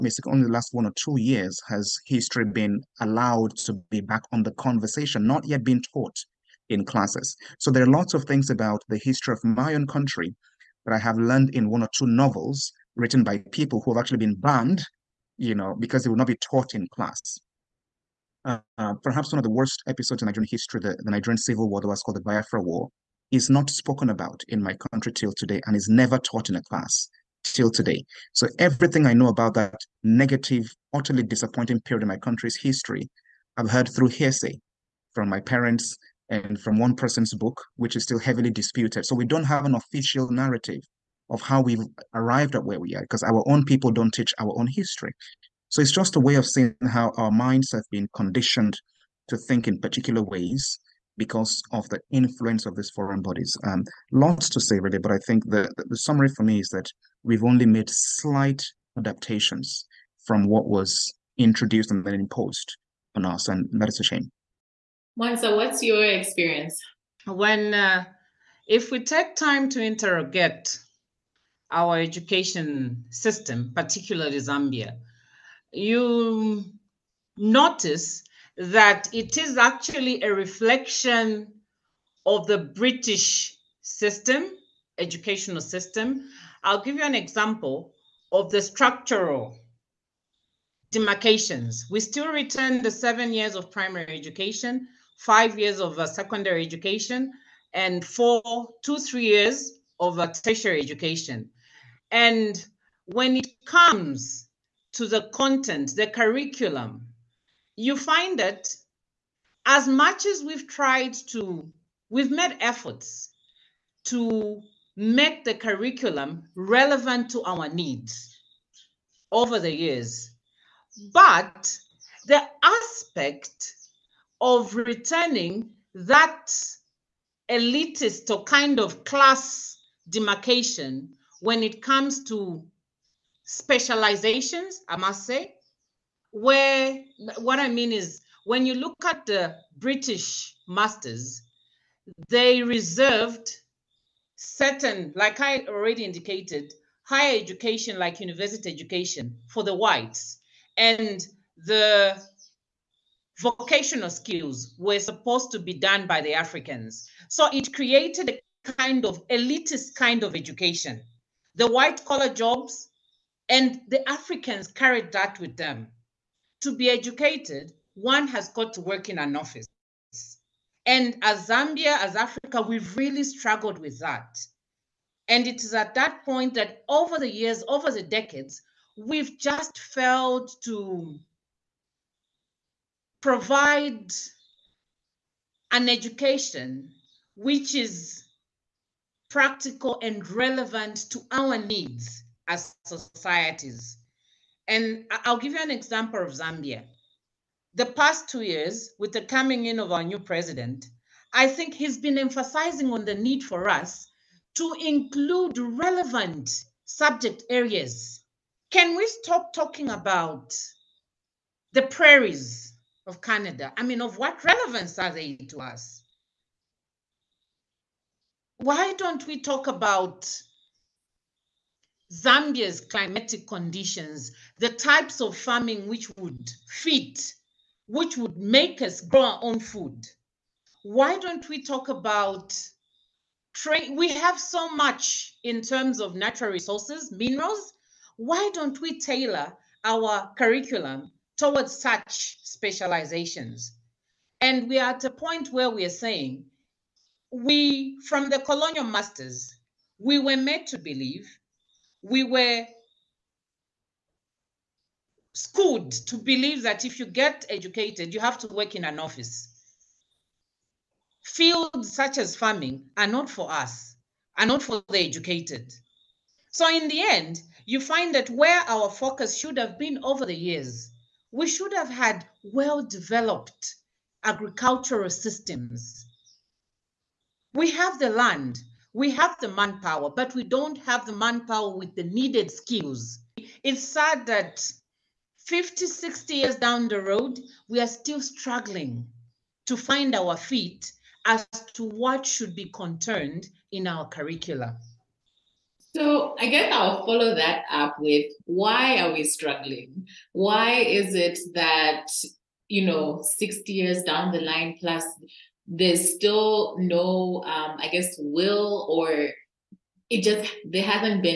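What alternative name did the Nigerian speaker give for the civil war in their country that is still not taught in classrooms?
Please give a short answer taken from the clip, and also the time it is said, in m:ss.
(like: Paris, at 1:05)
Biafra War, at 0:22.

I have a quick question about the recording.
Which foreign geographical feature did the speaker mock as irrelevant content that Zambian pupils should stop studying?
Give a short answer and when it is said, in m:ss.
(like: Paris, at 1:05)
prairies of Canada, at 3:31.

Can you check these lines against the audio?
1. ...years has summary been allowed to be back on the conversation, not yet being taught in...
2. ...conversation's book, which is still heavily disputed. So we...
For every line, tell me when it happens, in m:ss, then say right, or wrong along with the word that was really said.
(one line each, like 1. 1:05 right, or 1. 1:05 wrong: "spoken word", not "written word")
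1. 0:01 wrong: "history", not "summary"
2. 0:36 wrong: "person", not "conversation".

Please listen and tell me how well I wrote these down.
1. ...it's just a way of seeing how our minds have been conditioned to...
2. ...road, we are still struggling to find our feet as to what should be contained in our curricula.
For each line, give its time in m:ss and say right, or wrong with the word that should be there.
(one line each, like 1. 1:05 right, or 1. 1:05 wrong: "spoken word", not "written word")
1. 0:45 right
2. 4:47 right.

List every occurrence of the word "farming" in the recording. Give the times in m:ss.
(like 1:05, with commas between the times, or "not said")
3:45, 4:22.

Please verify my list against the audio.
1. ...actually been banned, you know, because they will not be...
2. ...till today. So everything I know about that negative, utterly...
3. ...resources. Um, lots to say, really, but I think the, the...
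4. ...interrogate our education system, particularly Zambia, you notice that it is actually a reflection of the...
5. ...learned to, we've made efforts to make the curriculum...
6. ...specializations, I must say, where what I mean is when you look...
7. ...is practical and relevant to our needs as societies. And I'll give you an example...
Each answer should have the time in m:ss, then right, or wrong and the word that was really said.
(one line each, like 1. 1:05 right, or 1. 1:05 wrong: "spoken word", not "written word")
1. 0:14 right
2. 0:27 right
3. 0:53 wrong: "bodies", not "resources"
4. 1:09 right
5. 1:50 wrong: "tried", not "learned"
6. 2:13 right
7. 3:07 right.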